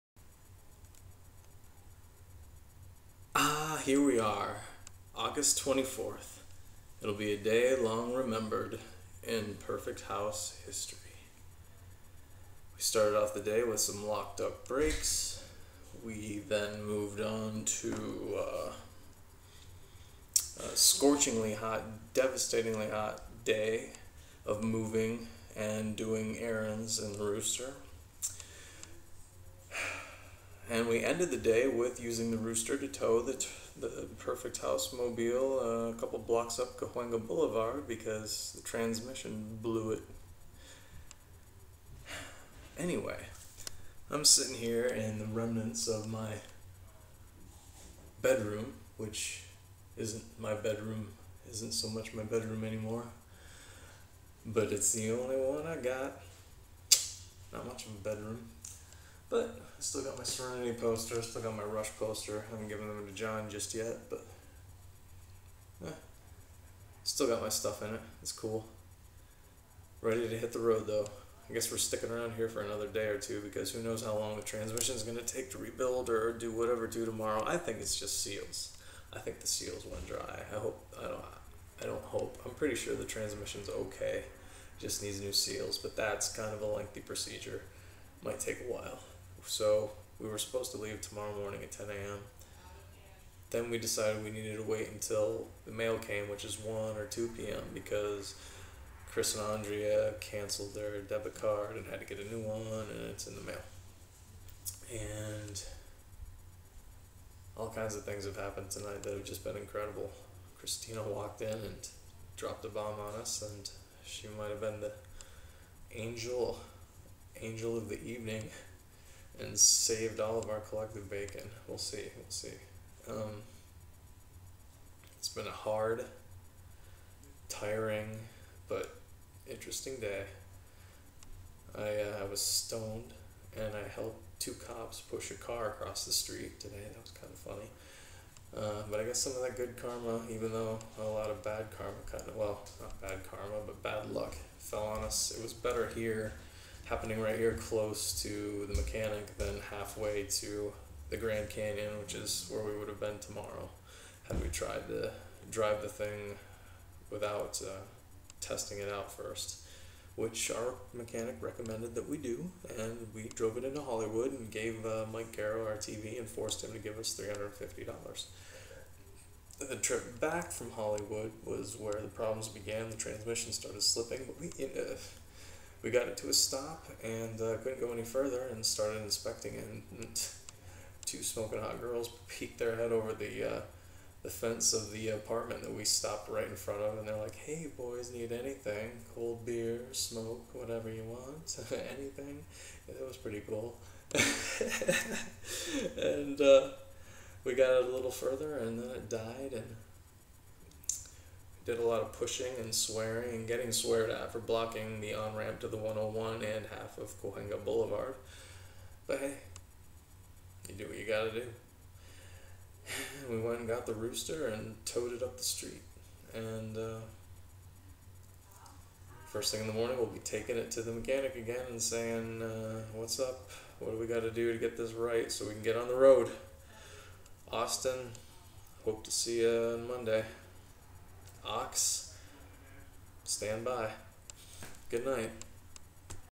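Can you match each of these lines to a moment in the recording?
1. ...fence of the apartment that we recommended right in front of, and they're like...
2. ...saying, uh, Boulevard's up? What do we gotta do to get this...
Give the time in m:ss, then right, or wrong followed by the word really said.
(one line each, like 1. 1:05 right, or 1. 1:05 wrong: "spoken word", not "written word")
1. 3:04 wrong: "stopped", not "recommended"
2. 3:41 wrong: "What", not "Boulevard".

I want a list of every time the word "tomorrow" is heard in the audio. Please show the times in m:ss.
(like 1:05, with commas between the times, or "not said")
1:17, 1:31, 2:33.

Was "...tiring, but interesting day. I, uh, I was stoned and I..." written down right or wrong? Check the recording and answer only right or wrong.
right.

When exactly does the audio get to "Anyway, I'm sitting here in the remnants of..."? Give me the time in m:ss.
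0:42.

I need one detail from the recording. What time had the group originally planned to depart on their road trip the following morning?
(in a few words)
10 a.m.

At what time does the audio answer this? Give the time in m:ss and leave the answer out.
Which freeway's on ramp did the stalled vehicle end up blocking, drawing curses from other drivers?
3:25.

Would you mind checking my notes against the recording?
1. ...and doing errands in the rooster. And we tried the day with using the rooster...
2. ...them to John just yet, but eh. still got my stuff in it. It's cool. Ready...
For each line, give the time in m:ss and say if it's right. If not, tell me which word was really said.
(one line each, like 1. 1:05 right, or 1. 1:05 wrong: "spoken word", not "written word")
1. 0:25 wrong: "ended", not "tried"
2. 1:02 right.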